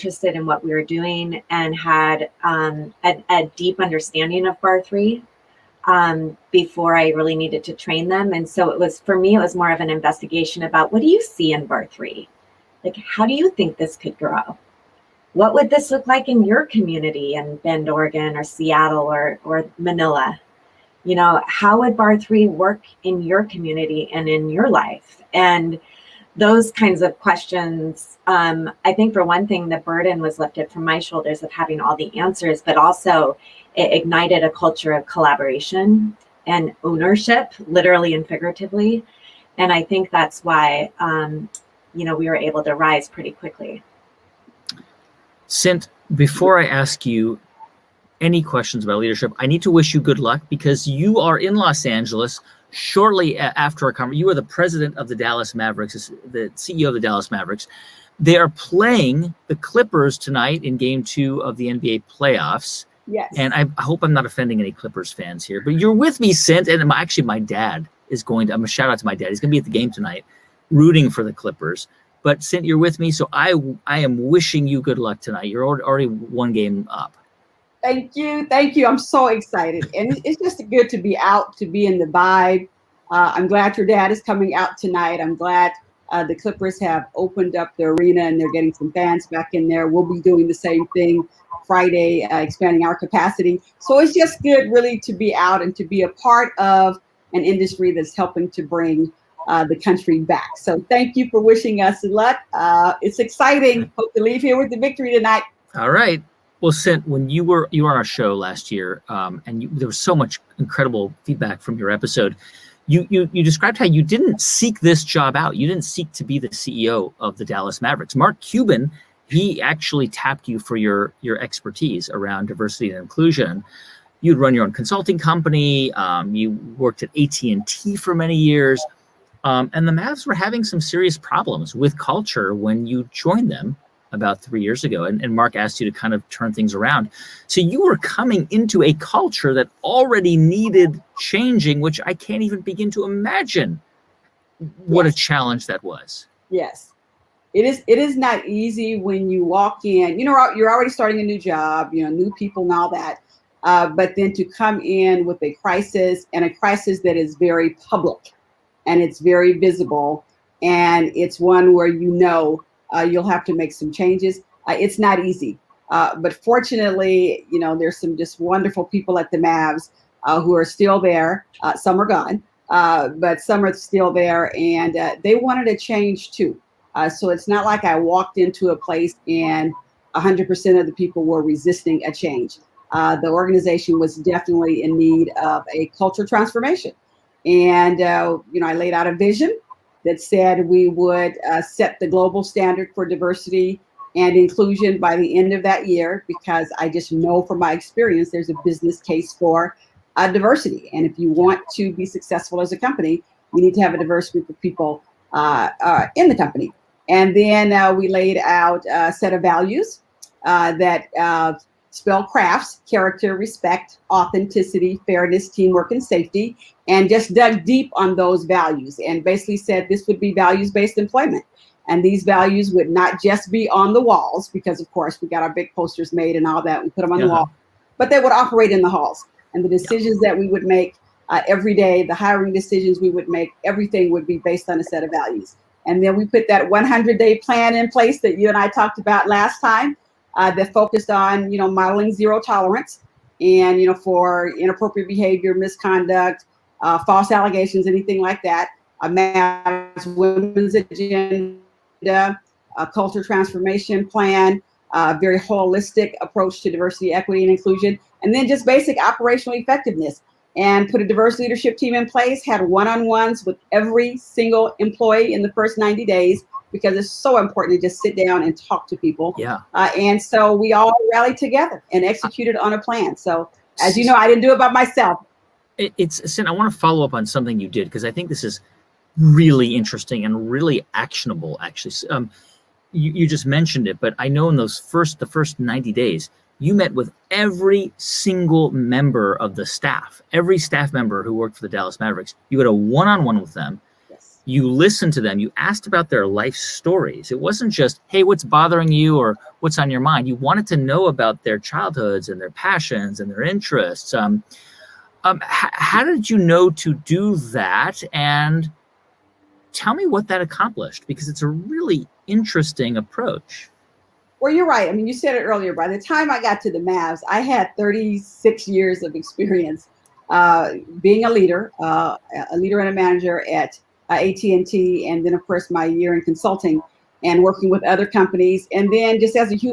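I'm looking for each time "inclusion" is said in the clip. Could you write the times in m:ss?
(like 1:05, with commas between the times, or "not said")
2:03, 3:14, 4:17.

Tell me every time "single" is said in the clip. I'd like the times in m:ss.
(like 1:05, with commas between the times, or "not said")
4:24, 4:47.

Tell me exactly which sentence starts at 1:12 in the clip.
But since you're with me, so I I am wishing you good luck tonight.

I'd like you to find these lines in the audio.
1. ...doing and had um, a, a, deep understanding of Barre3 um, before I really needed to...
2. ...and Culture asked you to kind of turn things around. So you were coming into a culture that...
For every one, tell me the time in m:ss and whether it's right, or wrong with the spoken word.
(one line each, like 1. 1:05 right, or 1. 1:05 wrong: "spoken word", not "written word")
1. 0:00 right
2. 2:15 wrong: "Mark", not "Culture".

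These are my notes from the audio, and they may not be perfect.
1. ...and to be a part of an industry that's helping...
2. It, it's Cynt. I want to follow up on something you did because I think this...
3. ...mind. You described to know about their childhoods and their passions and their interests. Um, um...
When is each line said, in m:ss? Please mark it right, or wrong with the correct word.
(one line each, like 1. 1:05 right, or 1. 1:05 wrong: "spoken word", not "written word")
1. 1:35 right
2. 4:35 right
3. 5:00 wrong: "wanted", not "described".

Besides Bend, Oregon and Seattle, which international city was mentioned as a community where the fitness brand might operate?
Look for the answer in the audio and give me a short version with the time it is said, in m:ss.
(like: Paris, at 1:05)
Manila, at 0:19.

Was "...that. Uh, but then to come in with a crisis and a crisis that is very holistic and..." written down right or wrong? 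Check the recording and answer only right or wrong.
wrong.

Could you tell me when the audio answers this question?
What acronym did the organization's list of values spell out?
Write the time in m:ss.
3:32.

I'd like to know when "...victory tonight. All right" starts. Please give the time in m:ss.
1:44.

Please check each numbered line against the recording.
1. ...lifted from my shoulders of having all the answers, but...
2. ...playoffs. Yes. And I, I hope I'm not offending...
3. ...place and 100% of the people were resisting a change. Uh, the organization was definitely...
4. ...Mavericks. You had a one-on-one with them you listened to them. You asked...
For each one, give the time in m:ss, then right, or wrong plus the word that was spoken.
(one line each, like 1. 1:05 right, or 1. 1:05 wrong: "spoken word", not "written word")
1. 0:30 right
2. 1:02 right
3. 2:58 right
4. 4:51 right.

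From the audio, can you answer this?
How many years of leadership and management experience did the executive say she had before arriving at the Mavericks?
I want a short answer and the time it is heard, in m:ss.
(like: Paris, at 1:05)
36, at 5:17.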